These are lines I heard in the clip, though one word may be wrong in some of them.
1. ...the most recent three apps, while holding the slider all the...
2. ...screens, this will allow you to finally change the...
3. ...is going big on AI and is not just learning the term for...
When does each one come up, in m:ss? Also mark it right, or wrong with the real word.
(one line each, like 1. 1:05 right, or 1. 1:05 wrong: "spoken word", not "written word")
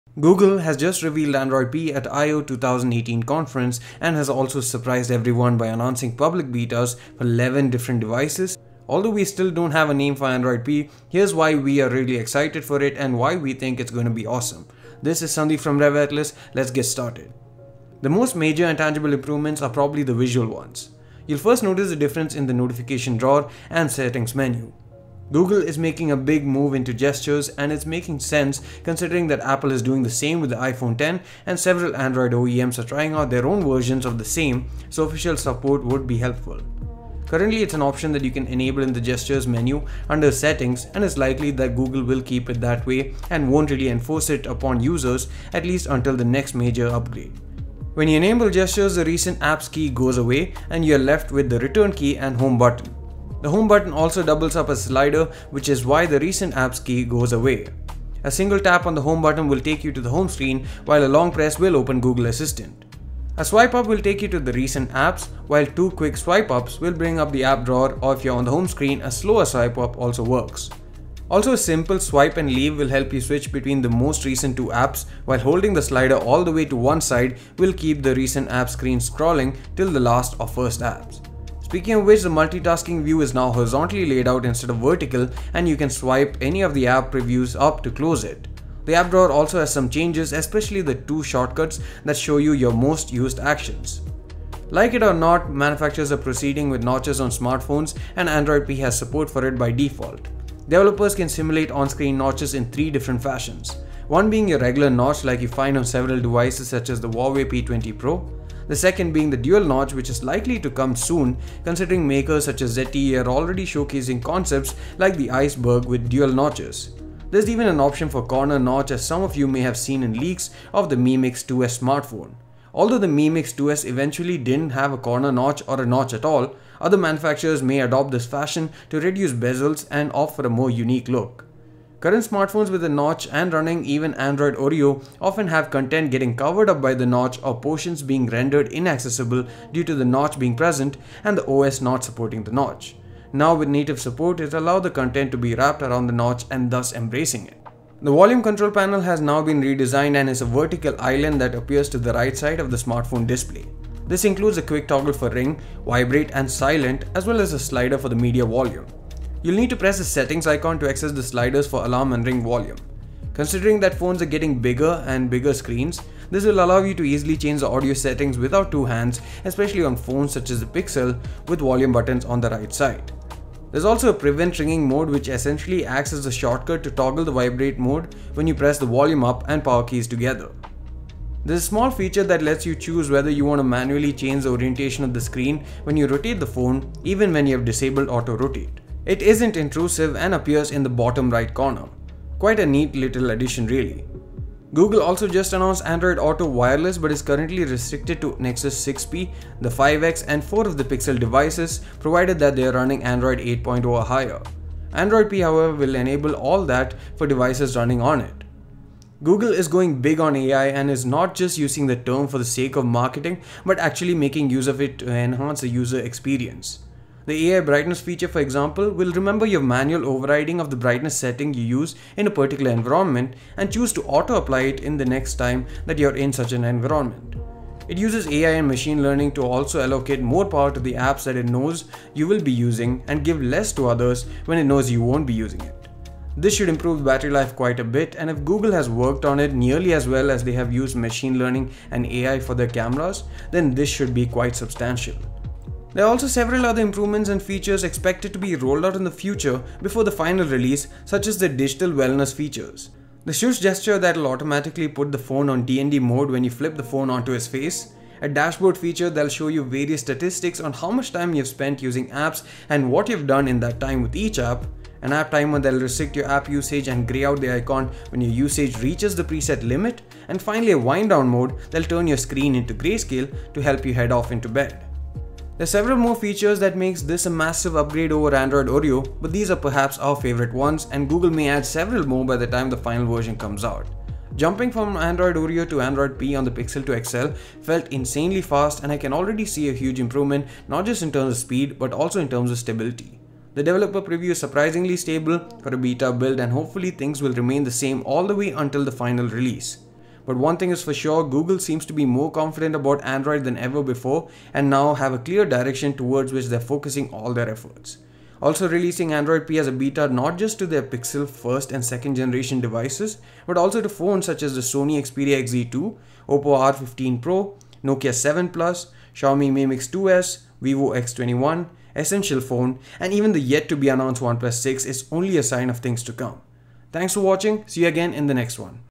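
1. 1:13 wrong: "two", not "three"
2. 2:45 wrong: "easily", not "finally"
3. 3:29 wrong: "using", not "learning".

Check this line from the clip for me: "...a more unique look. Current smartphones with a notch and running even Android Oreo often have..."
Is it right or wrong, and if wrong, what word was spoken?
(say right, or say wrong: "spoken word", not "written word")
right.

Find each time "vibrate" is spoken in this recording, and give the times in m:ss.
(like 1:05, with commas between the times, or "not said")
2:35, 2:57.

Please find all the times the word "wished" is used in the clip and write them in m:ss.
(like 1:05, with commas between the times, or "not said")
not said.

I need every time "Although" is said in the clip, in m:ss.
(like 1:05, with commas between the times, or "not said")
0:08, 2:02.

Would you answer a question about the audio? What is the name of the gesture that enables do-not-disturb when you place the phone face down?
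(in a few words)
Shush.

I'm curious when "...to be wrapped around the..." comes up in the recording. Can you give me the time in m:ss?
2:25.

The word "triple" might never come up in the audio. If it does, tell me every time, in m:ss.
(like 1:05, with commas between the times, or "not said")
not said.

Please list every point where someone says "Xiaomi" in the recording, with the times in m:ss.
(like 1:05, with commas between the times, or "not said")
5:19.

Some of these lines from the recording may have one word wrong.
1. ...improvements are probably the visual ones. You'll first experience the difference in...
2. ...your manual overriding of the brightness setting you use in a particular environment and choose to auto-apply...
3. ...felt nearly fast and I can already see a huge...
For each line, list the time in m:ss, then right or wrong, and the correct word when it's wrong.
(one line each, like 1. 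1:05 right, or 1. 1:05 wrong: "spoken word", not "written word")
1. 0:19 wrong: "notice", not "experience"
2. 3:39 right
3. 4:47 wrong: "insanely", not "nearly".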